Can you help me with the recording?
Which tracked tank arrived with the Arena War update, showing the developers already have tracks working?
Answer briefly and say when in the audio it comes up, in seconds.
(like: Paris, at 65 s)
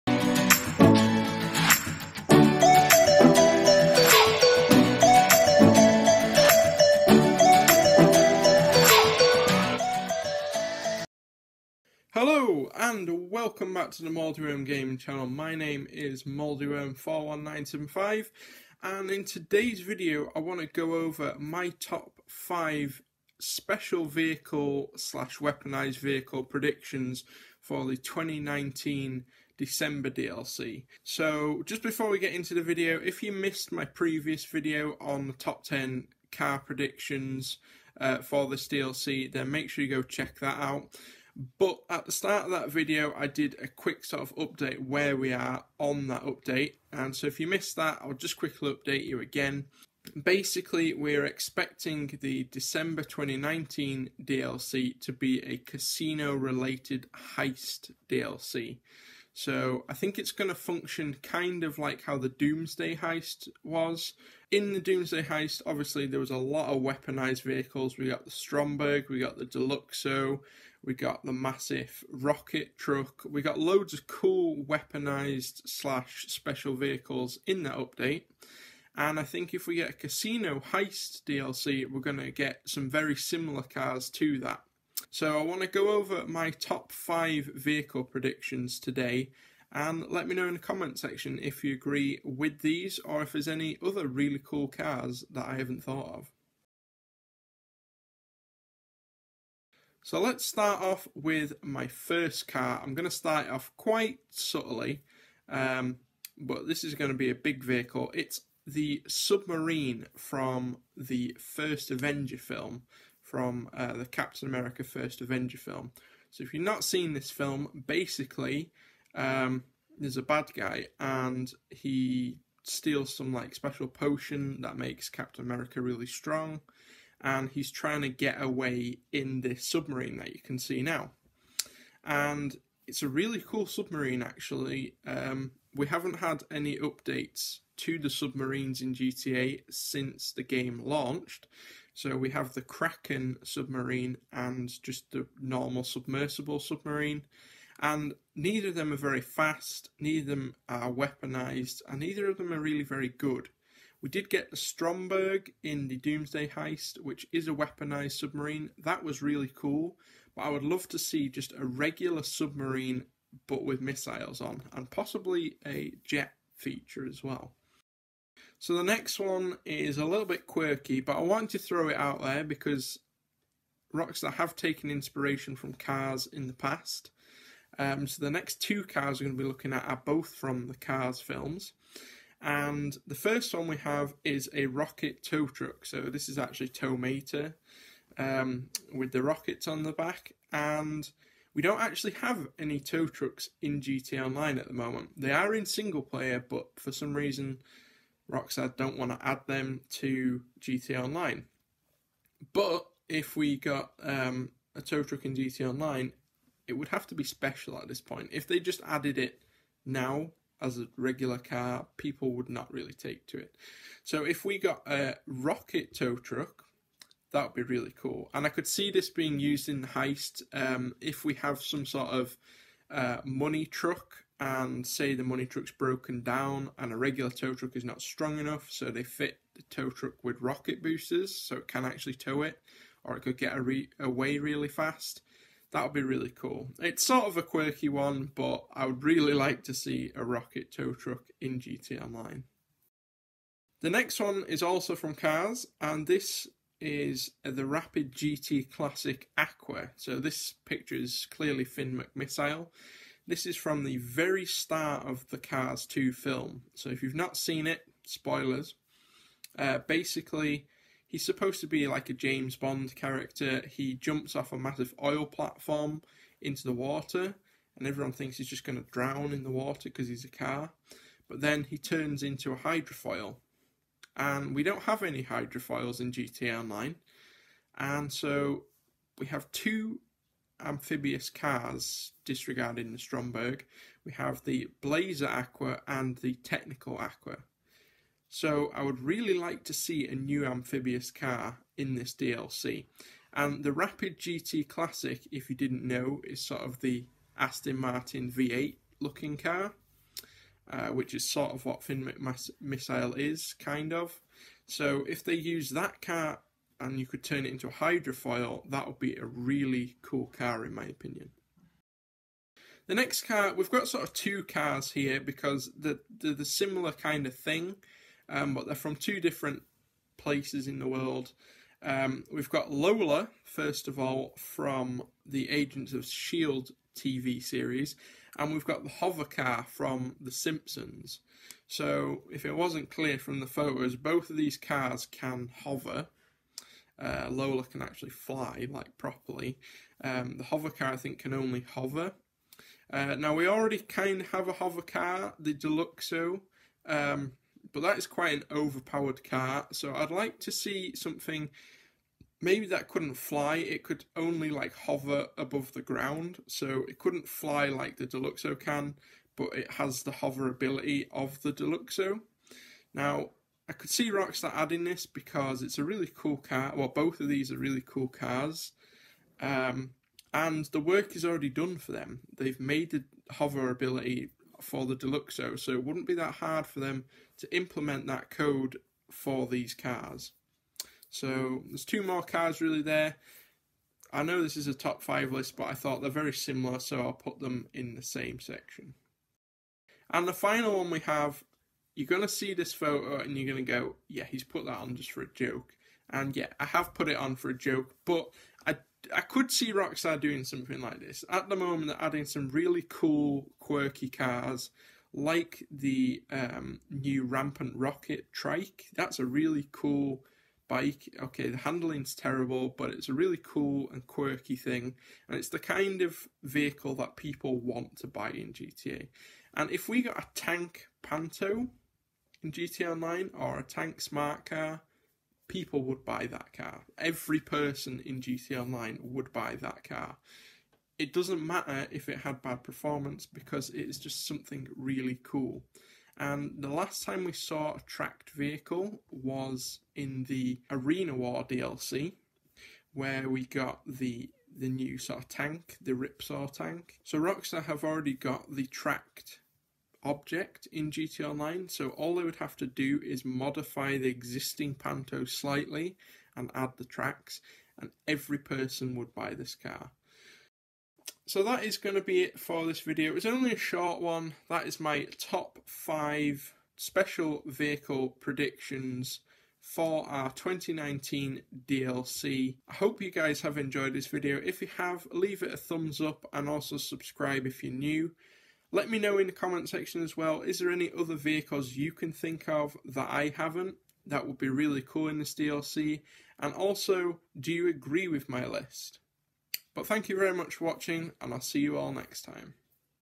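Ripsaw, at 445 s.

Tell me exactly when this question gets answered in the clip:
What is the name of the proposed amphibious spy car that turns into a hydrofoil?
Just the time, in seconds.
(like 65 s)
247 s.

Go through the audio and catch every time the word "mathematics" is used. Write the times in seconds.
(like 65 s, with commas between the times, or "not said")
not said.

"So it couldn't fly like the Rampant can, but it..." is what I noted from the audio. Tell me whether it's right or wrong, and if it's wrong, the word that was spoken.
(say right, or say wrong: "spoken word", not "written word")
wrong: "Deluxo", not "Rampant".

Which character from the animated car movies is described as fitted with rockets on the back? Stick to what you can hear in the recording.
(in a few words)
Tow Mater.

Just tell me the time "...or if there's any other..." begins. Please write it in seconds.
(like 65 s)
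93 s.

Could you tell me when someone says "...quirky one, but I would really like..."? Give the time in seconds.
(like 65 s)
237 s.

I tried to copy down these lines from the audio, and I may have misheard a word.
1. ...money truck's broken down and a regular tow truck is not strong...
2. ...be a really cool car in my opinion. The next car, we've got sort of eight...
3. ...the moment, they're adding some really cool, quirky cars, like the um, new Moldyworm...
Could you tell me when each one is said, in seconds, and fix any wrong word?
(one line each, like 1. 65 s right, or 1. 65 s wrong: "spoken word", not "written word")
1. 225 s right
2. 308 s wrong: "two", not "eight"
3. 401 s wrong: "Rampant", not "Moldyworm".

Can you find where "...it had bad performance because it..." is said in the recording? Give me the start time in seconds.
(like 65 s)
432 s.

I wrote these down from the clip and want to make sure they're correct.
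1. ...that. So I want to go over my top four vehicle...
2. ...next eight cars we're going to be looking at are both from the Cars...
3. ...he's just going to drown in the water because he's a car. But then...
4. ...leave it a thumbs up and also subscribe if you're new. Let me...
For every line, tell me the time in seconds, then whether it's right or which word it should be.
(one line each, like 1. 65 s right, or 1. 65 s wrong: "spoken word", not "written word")
1. 84 s wrong: "five", not "four"
2. 178 s wrong: "two", not "eight"
3. 268 s right
4. 475 s right.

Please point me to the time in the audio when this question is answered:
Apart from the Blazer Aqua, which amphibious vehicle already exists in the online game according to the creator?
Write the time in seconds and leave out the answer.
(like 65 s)
286 s.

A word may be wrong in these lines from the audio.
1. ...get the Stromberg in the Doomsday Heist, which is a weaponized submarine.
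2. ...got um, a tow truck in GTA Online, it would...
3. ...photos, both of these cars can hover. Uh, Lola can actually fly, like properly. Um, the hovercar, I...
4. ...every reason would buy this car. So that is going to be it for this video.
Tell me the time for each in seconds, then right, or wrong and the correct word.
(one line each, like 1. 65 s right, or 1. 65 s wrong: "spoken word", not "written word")
1. 154 s right
2. 203 s right
3. 333 s right
4. 458 s wrong: "person", not "reason".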